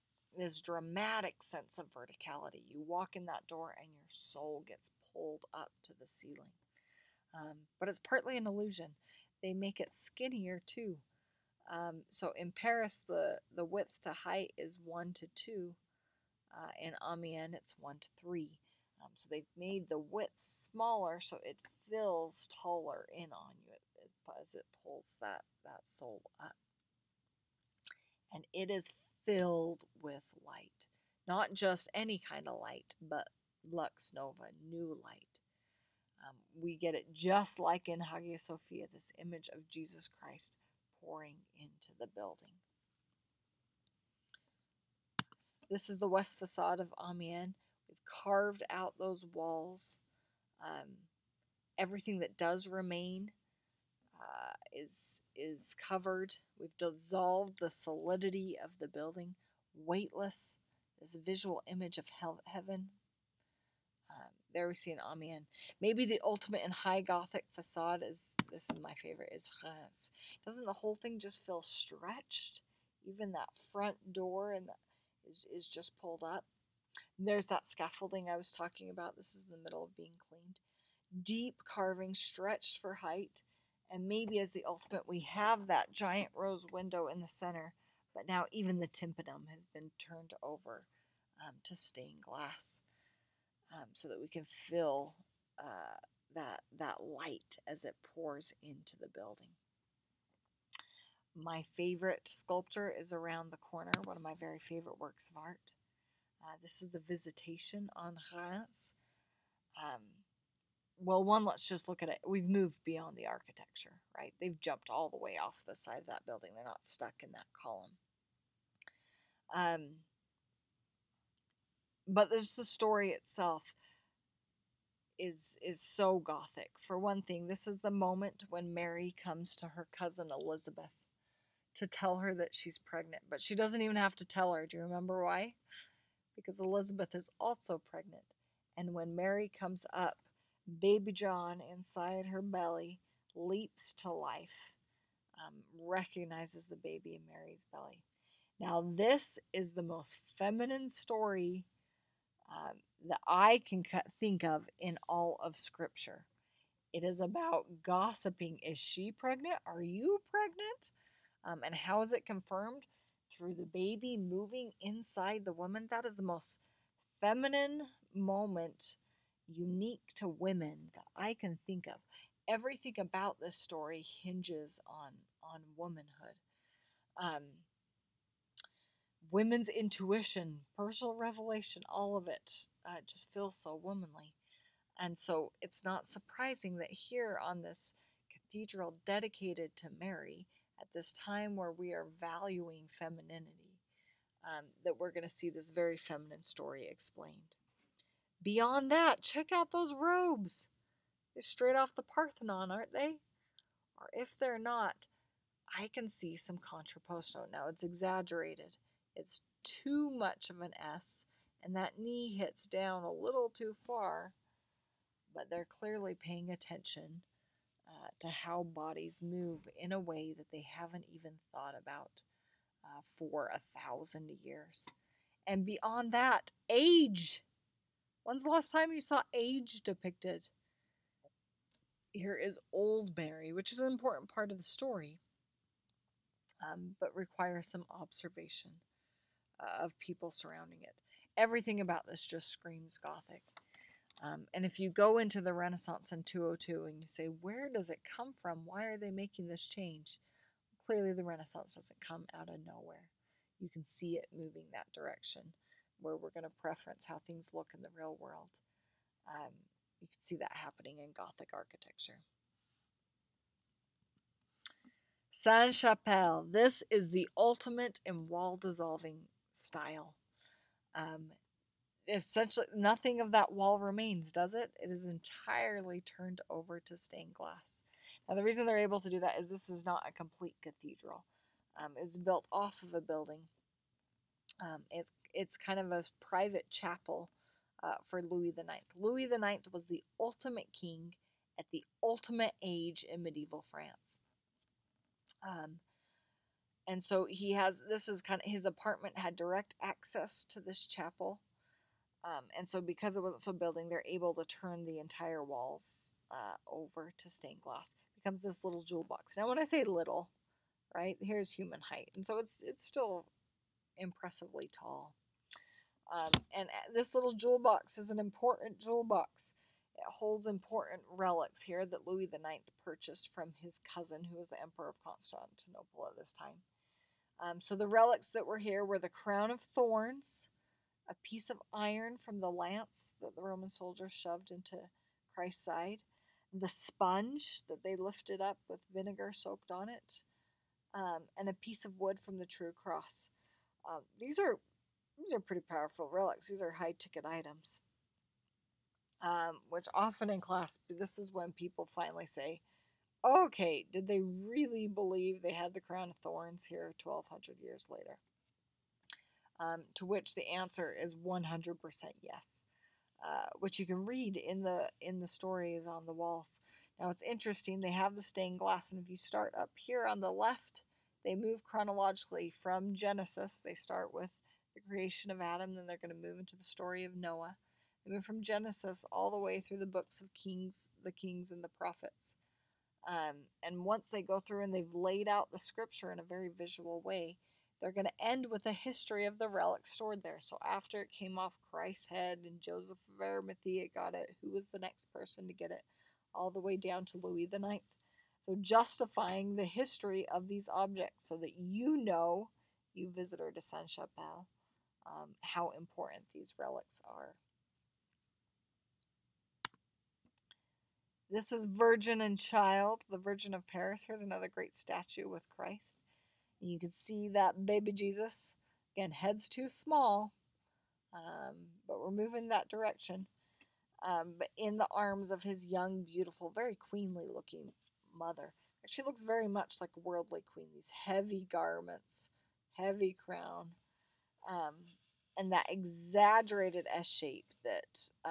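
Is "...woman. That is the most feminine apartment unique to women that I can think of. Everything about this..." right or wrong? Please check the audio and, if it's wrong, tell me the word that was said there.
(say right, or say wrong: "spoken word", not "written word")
wrong: "moment", not "apartment".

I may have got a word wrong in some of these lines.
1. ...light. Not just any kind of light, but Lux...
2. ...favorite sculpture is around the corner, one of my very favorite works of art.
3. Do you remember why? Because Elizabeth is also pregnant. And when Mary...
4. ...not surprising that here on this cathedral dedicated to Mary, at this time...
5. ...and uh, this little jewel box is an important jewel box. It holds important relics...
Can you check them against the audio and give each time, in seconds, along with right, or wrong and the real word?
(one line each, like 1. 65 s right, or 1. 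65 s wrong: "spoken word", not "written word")
1. 30 s right
2. 101 s right
3. 134 s right
4. 185 s right
5. 316 s right.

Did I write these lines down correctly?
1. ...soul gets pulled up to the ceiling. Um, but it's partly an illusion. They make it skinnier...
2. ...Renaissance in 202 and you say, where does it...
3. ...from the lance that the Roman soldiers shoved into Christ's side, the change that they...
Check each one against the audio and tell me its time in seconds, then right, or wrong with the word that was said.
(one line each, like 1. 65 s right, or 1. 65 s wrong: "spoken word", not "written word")
1. 4 s right
2. 245 s right
3. 332 s wrong: "sponge", not "change".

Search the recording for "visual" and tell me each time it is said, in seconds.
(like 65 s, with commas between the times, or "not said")
61 s, 386 s.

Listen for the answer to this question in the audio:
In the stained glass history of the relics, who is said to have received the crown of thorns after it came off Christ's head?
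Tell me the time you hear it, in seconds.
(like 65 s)
392 s.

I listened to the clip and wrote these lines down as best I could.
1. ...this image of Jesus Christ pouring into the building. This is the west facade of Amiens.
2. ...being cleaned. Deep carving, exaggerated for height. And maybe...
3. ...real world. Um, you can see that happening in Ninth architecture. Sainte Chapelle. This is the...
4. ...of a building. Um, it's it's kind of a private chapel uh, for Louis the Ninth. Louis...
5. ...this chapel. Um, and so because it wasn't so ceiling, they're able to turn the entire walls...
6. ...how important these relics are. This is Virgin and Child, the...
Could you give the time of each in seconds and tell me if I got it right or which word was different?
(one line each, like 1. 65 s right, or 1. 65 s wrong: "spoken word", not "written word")
1. 38 s right
2. 79 s wrong: "stretched", not "exaggerated"
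3. 257 s wrong: "Gothic", not "Ninth"
4. 282 s right
5. 300 s wrong: "building", not "ceiling"
6. 405 s right.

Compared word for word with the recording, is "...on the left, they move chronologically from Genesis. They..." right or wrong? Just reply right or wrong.
right.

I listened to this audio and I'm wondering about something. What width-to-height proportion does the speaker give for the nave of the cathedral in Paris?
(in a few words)
1 to 2.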